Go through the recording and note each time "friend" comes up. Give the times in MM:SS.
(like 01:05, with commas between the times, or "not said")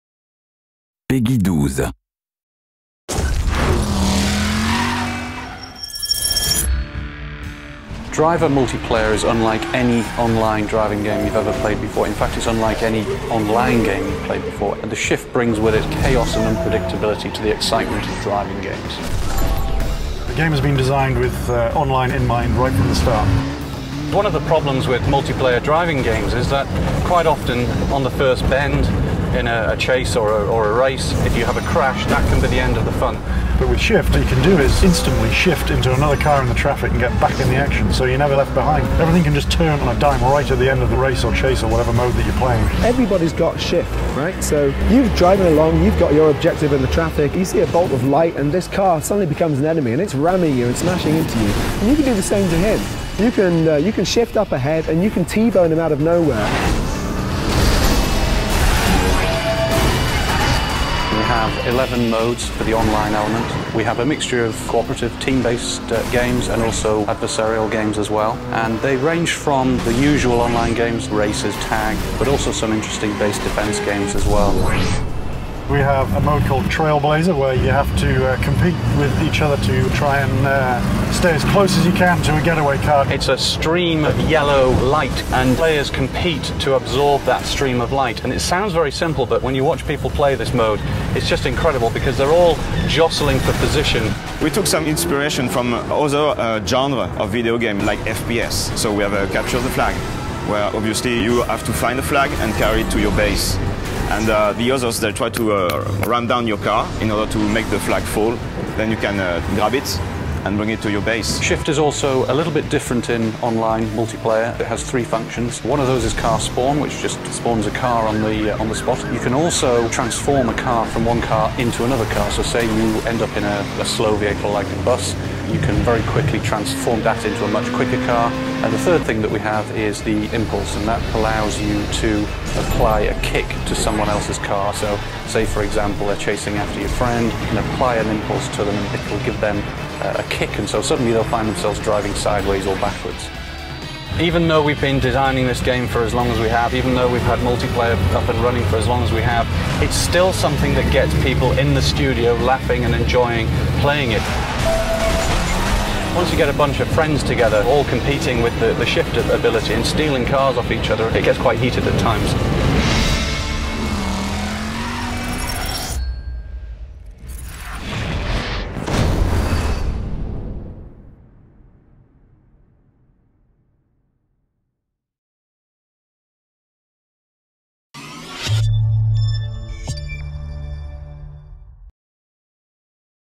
02:16, 02:36.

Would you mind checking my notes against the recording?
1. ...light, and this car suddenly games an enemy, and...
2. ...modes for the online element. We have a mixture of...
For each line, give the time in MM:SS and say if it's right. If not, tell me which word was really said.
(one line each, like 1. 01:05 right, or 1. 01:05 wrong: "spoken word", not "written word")
1. 00:48 wrong: "becomes", not "games"
2. 01:02 right.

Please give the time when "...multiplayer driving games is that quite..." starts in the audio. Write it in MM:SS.
00:25.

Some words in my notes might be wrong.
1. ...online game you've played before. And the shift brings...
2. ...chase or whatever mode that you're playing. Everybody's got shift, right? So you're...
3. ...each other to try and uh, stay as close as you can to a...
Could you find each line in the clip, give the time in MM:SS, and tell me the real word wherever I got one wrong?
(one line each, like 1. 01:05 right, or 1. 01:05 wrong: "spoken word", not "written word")
1. 00:13 right
2. 00:41 right
3. 01:19 right.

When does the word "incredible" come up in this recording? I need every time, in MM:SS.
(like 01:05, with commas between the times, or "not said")
01:31.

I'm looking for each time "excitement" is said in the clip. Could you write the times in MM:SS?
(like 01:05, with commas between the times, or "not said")
00:17.